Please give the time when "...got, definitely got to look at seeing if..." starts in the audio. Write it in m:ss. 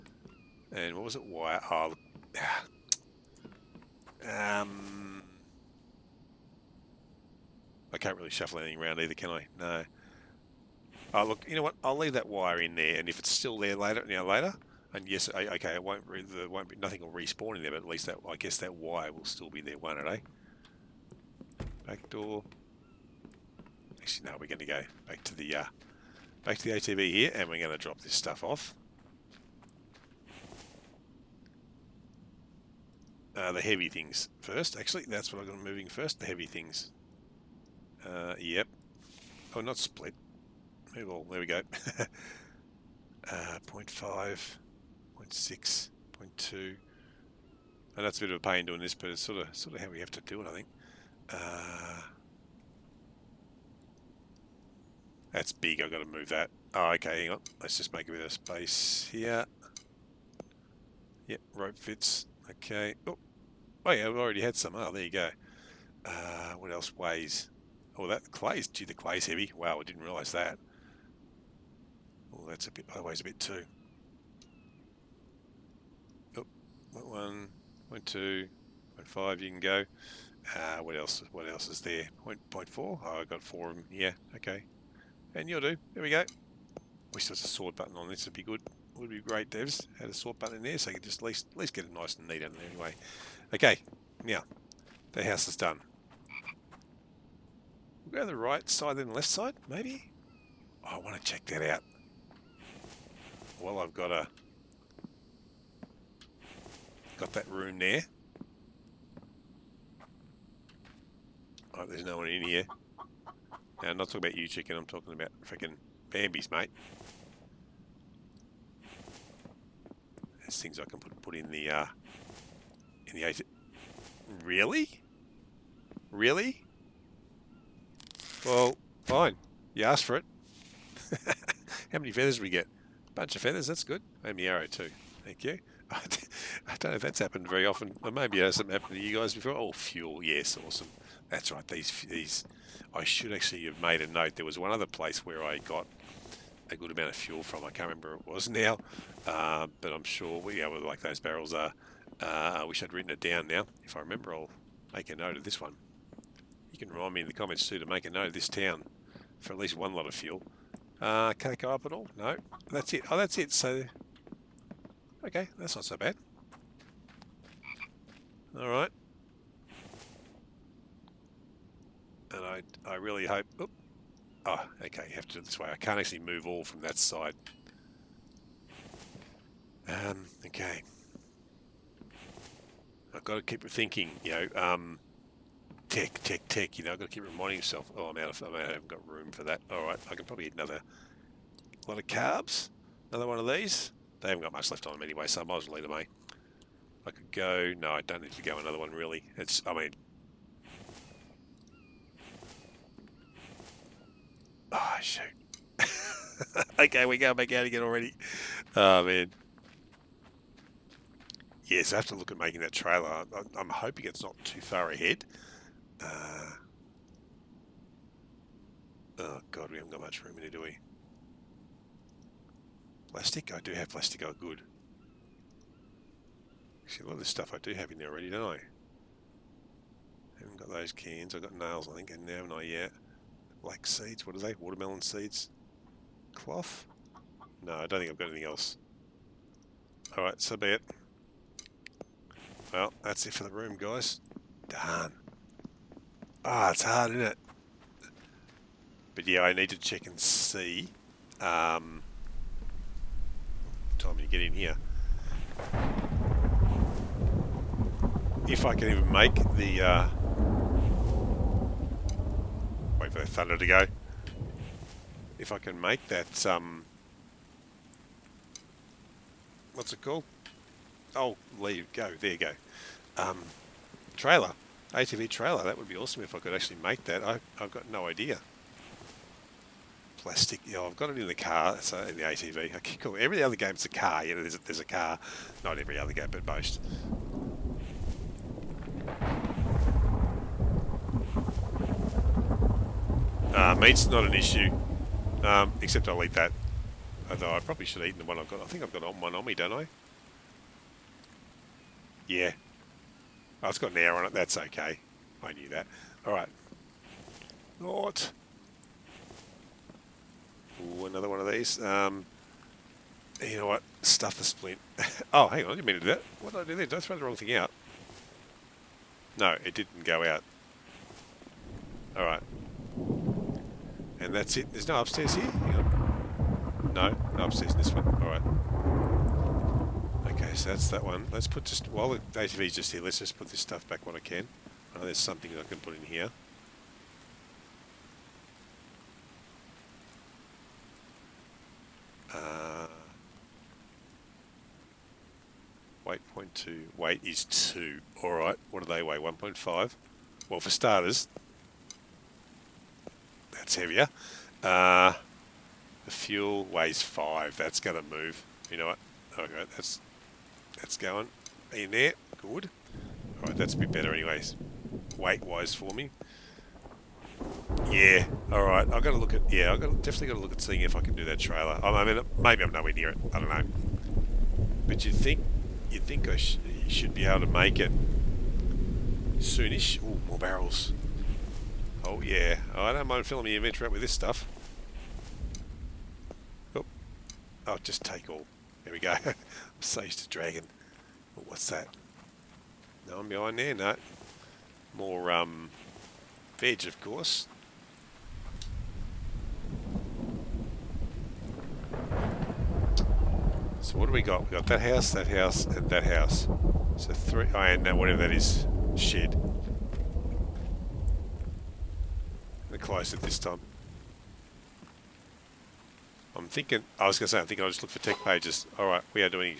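6:09.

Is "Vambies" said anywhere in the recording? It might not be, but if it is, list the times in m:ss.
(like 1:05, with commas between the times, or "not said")
1:56.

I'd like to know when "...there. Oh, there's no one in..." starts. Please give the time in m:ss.
1:47.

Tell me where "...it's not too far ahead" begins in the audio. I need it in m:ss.
3:34.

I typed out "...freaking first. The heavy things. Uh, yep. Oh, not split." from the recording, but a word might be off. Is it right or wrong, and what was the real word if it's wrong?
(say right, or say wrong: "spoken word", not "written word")
wrong: "moving", not "freaking".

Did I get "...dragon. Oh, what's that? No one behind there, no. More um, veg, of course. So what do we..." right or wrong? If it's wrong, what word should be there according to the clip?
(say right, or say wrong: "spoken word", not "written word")
right.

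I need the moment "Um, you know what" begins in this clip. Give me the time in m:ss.
5:11.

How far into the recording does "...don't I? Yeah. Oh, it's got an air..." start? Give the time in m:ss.
4:59.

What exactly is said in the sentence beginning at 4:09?
But yeah, I need to check and see um, time you get in here.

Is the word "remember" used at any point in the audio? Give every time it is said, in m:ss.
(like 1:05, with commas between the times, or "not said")
2:27, 2:33.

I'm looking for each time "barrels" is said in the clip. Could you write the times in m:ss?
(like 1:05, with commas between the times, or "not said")
2:31, 6:20.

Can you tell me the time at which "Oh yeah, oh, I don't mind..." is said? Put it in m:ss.
6:22.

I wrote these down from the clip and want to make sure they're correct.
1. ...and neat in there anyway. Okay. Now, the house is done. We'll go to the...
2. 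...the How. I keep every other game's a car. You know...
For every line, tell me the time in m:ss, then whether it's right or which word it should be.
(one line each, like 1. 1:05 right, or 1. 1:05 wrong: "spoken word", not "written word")
1. 1:32 right
2. 4:42 wrong: "ATV", not "How".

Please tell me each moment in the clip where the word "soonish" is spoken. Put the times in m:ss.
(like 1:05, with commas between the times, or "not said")
6:19.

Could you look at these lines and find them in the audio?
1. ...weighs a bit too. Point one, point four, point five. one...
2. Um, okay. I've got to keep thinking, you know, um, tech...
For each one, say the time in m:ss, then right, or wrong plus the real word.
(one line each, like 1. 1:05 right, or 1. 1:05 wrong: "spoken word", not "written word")
1. 1:13 wrong: "two", not "four"
2. 2:59 right.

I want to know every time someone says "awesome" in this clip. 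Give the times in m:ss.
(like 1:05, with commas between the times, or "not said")
2:20, 4:35.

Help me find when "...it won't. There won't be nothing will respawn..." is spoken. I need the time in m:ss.
0:15.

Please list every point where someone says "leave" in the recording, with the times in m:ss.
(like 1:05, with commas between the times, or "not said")
0:11, 3:15, 4:31.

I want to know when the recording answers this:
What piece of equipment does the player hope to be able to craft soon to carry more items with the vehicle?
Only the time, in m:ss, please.
4:34.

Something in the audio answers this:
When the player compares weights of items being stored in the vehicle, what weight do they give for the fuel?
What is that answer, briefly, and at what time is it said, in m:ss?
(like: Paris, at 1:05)
5, at 5:56.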